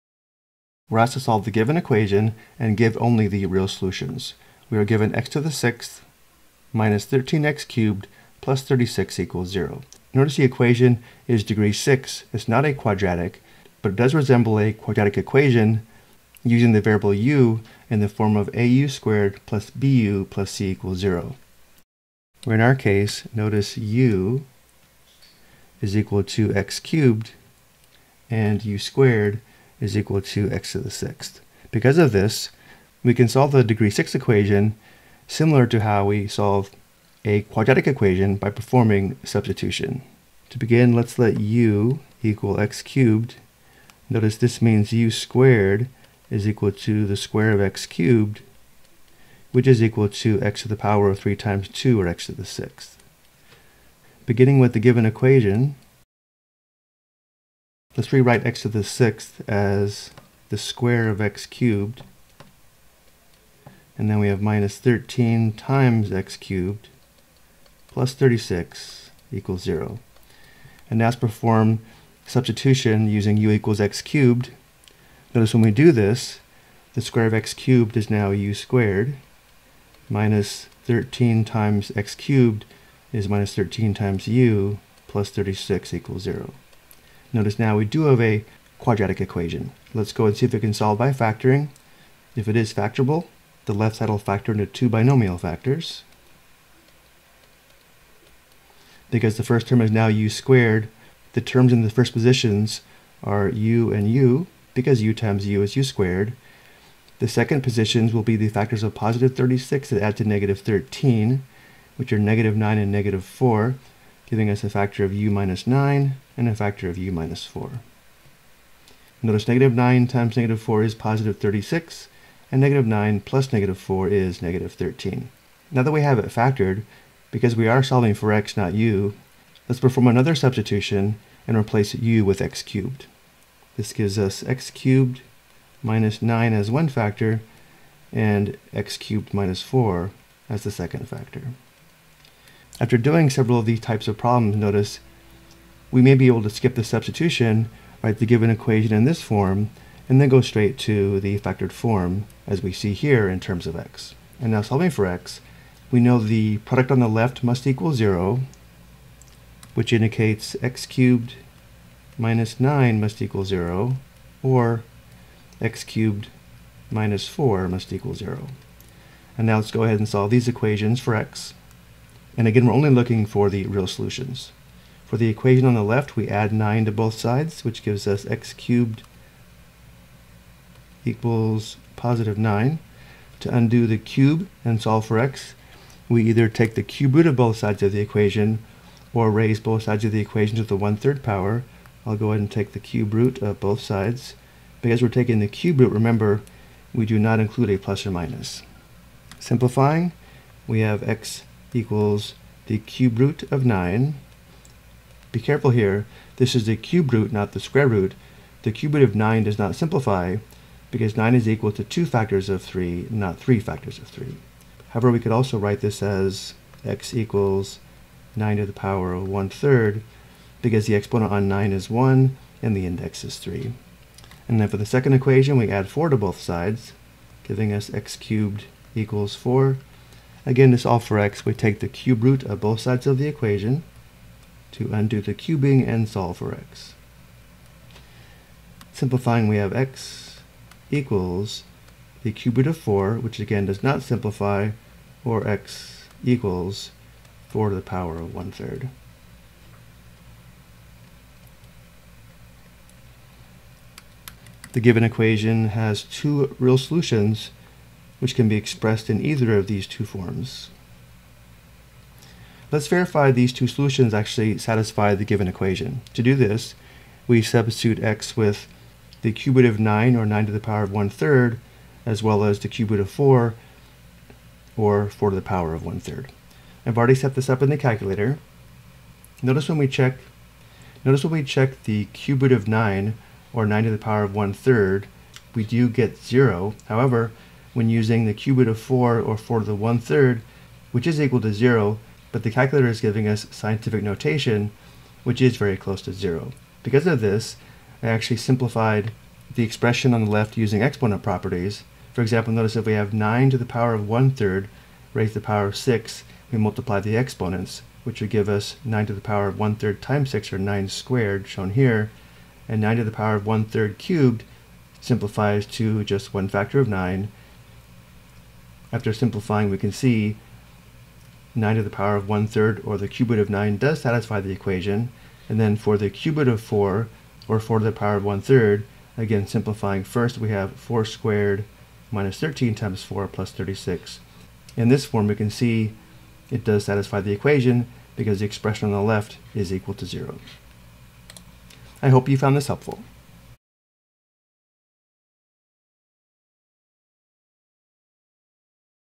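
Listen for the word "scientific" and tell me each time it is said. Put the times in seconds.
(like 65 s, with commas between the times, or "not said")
293 s.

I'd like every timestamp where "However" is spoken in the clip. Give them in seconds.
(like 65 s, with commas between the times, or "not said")
214 s, 286 s.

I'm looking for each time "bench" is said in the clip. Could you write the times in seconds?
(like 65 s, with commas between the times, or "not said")
not said.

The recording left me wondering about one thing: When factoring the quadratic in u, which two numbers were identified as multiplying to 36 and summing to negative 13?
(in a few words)
-9 and -4.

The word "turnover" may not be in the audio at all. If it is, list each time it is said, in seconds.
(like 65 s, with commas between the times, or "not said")
not said.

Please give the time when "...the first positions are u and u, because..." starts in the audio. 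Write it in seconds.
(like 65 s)
101 s.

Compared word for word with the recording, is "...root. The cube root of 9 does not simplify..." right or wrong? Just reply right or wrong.
right.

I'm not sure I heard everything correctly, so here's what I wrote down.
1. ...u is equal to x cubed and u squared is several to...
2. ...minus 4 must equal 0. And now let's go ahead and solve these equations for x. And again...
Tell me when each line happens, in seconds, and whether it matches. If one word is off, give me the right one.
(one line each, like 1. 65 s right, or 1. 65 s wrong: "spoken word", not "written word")
1. 23 s wrong: "equal", not "several"
2. 166 s right.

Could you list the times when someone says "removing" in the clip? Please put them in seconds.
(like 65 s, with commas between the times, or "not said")
not said.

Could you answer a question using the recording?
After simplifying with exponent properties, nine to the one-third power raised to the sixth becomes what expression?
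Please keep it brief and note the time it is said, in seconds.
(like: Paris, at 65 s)
9 squared, at 310 s.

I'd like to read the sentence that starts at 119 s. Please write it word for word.
Notice negative 9 times negative 4 is positive 36, and negative 9 plus negative 4 is negative 13.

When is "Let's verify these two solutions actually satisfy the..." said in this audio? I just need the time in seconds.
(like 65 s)
262 s.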